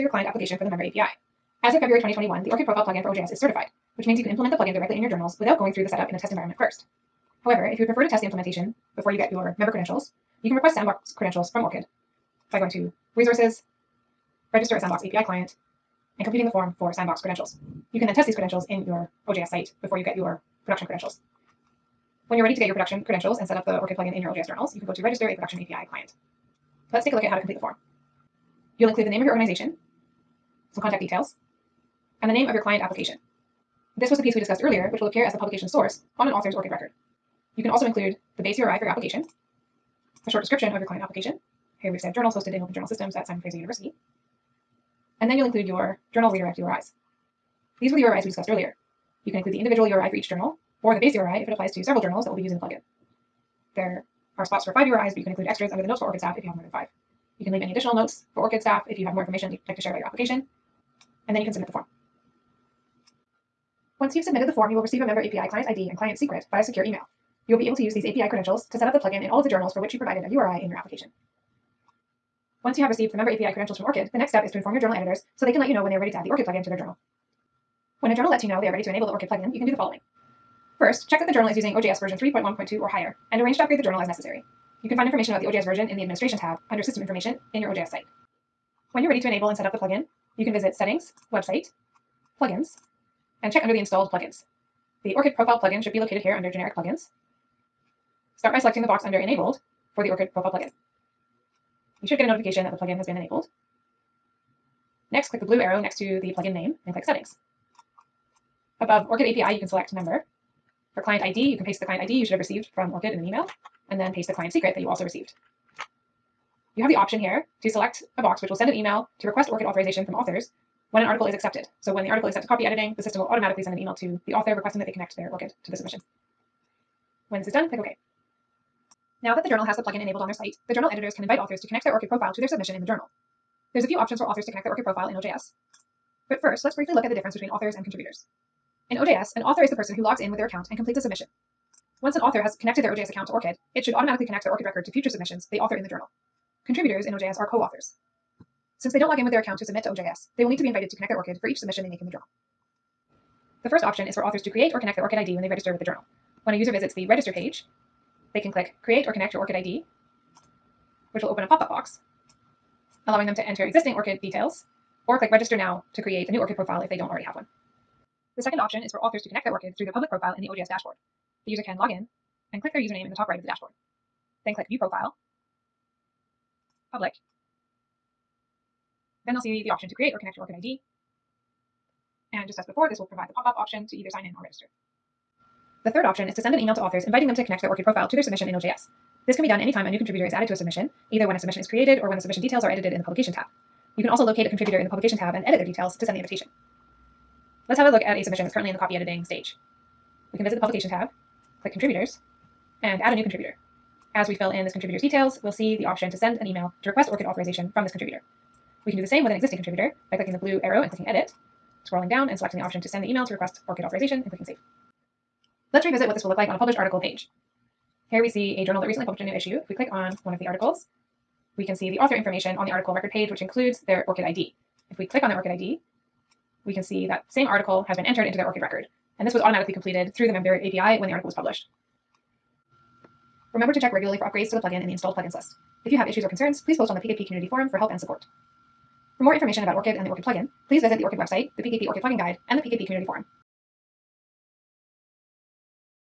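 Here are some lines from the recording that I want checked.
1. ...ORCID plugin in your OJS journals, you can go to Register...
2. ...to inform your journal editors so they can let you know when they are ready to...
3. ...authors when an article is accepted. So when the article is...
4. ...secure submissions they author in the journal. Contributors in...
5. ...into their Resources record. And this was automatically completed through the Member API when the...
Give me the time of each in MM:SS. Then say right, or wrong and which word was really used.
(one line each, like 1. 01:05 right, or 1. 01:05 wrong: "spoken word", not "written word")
1. 00:23 right
2. 01:14 right
3. 02:00 right
4. 02:24 wrong: "future", not "secure"
5. 03:48 wrong: "ORCID", not "Resources".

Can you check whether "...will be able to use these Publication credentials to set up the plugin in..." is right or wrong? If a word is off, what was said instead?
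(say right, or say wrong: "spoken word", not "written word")
wrong: "API", not "Publication".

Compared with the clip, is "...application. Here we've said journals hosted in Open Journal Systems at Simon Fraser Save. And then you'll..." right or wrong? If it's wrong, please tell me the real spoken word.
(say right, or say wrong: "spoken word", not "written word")
wrong: "University", not "Save".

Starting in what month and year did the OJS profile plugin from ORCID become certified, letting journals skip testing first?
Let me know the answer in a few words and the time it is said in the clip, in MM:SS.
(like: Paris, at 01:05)
February 2021, at 00:01.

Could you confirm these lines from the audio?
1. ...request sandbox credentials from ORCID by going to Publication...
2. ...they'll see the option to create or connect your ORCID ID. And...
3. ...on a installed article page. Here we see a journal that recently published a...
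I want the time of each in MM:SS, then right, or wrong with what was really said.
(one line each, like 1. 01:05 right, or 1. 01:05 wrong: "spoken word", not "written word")
1. 00:10 wrong: "Resources", not "Publication"
2. 02:59 right
3. 03:36 wrong: "published", not "installed".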